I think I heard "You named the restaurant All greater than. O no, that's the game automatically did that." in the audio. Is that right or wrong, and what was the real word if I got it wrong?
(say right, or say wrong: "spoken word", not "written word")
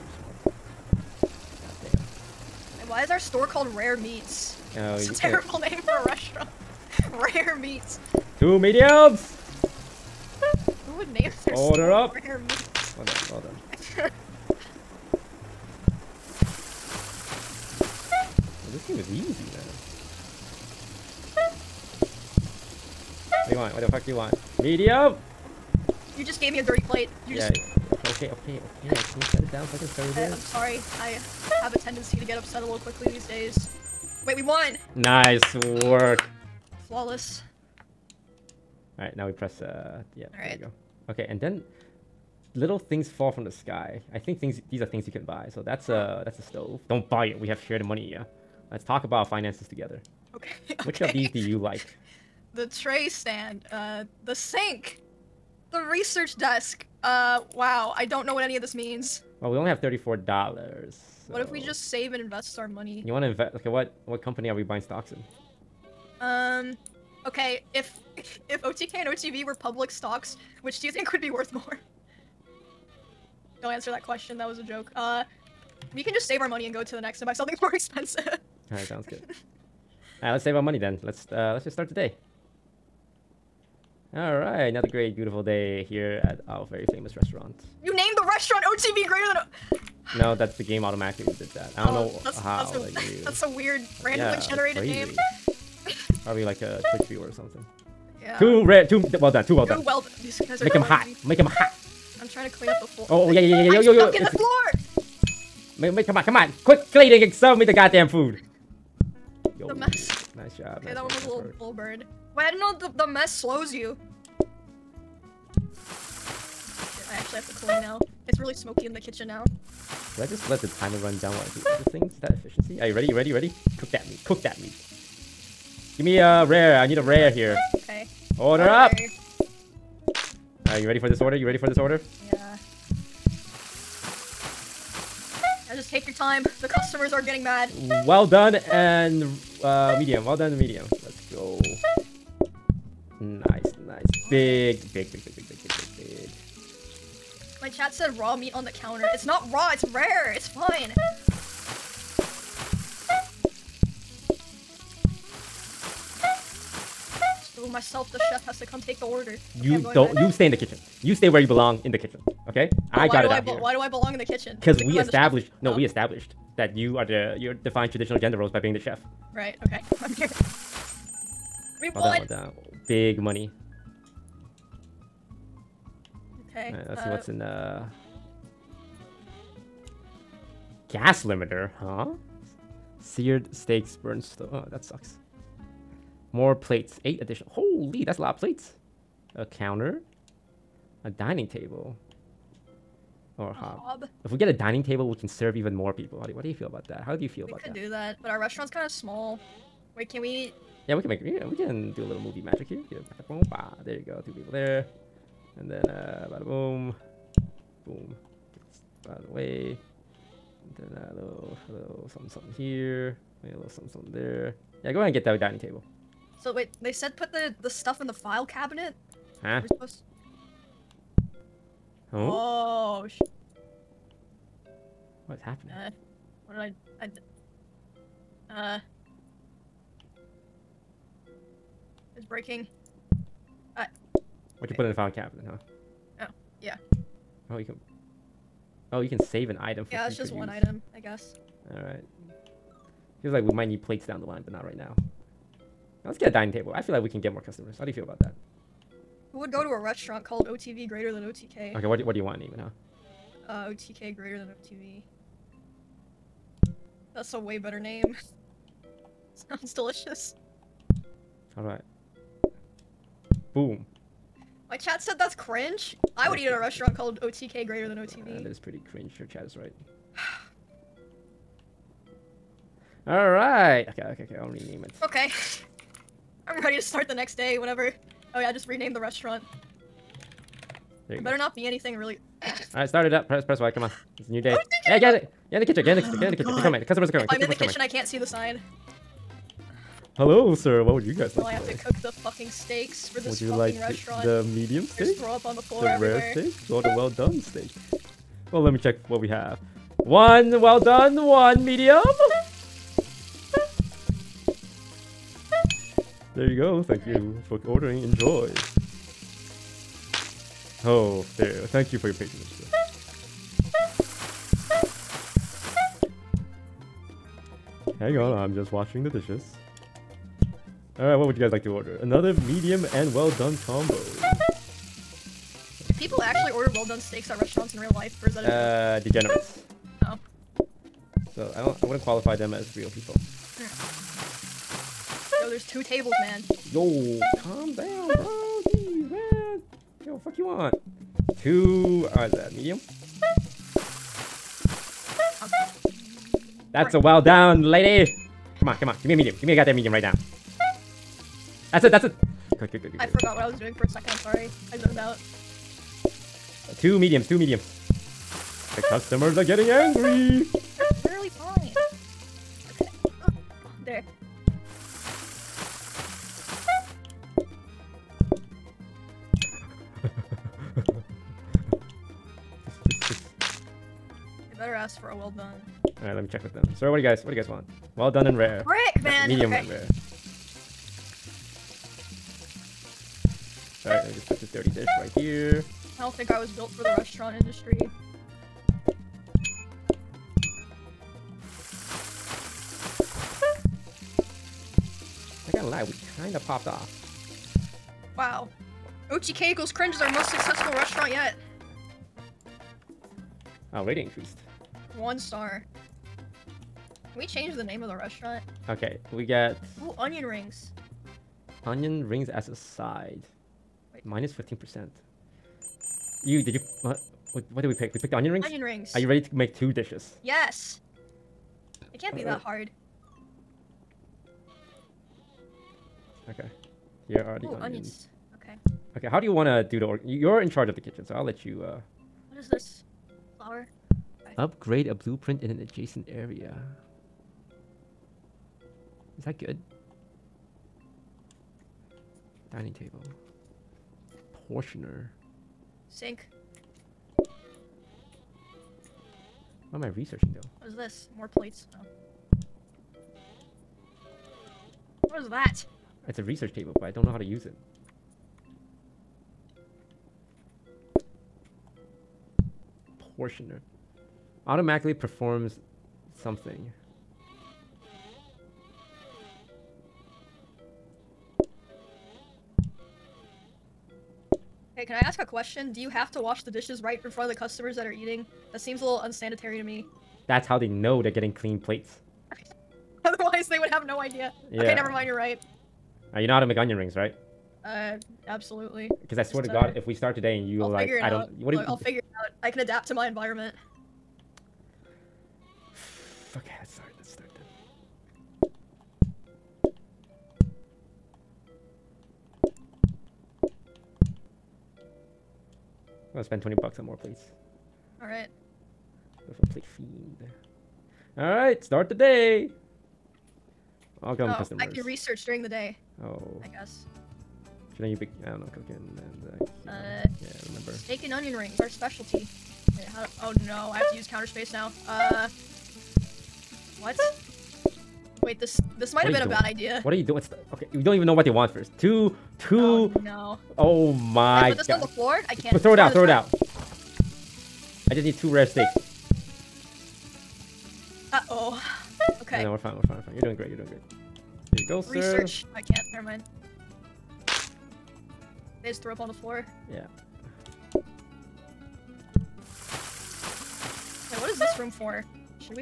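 wrong: "OTV", not "All".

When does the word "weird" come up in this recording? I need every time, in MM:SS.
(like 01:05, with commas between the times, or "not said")
01:33.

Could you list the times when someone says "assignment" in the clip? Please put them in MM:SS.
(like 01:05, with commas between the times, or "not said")
not said.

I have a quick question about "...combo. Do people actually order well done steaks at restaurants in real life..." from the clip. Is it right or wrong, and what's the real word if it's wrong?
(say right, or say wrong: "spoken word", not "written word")
right.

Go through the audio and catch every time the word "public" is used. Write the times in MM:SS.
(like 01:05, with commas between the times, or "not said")
01:09.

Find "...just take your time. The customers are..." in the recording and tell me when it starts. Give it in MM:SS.
02:15.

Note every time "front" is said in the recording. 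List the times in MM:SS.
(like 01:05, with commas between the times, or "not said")
07:57.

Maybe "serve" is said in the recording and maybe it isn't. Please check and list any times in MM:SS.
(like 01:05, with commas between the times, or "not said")
01:47, 03:15.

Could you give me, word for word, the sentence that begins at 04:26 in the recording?
I would eat at a restaurant called OTK greater than OTV.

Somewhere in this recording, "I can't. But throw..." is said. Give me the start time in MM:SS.
08:55.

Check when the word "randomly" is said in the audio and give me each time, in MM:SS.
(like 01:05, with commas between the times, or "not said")
01:34.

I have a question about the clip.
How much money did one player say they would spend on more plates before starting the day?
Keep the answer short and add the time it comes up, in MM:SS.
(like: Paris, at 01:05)
$20, at 08:26.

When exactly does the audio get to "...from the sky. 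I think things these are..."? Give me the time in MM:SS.
00:43.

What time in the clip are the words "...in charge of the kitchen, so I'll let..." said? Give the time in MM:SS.
07:10.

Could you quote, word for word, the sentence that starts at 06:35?
I gotta lie, we kinda popped off.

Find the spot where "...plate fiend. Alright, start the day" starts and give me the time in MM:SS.
08:29.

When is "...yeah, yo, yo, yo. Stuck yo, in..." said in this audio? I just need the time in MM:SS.
01:43.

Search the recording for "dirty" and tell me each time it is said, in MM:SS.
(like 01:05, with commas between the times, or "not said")
00:26, 06:24.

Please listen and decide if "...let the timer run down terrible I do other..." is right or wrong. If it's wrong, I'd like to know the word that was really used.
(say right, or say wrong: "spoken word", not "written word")
wrong: "while", not "terrible".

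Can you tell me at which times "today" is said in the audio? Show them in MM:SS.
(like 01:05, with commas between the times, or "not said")
04:51, 08:10.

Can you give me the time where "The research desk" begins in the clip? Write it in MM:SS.
00:55.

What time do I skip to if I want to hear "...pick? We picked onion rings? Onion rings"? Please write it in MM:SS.
06:57.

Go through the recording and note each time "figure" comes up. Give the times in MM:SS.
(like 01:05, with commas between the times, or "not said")
08:11.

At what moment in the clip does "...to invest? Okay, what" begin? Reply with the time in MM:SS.
01:03.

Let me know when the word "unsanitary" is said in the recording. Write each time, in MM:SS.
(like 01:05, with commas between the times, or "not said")
07:58.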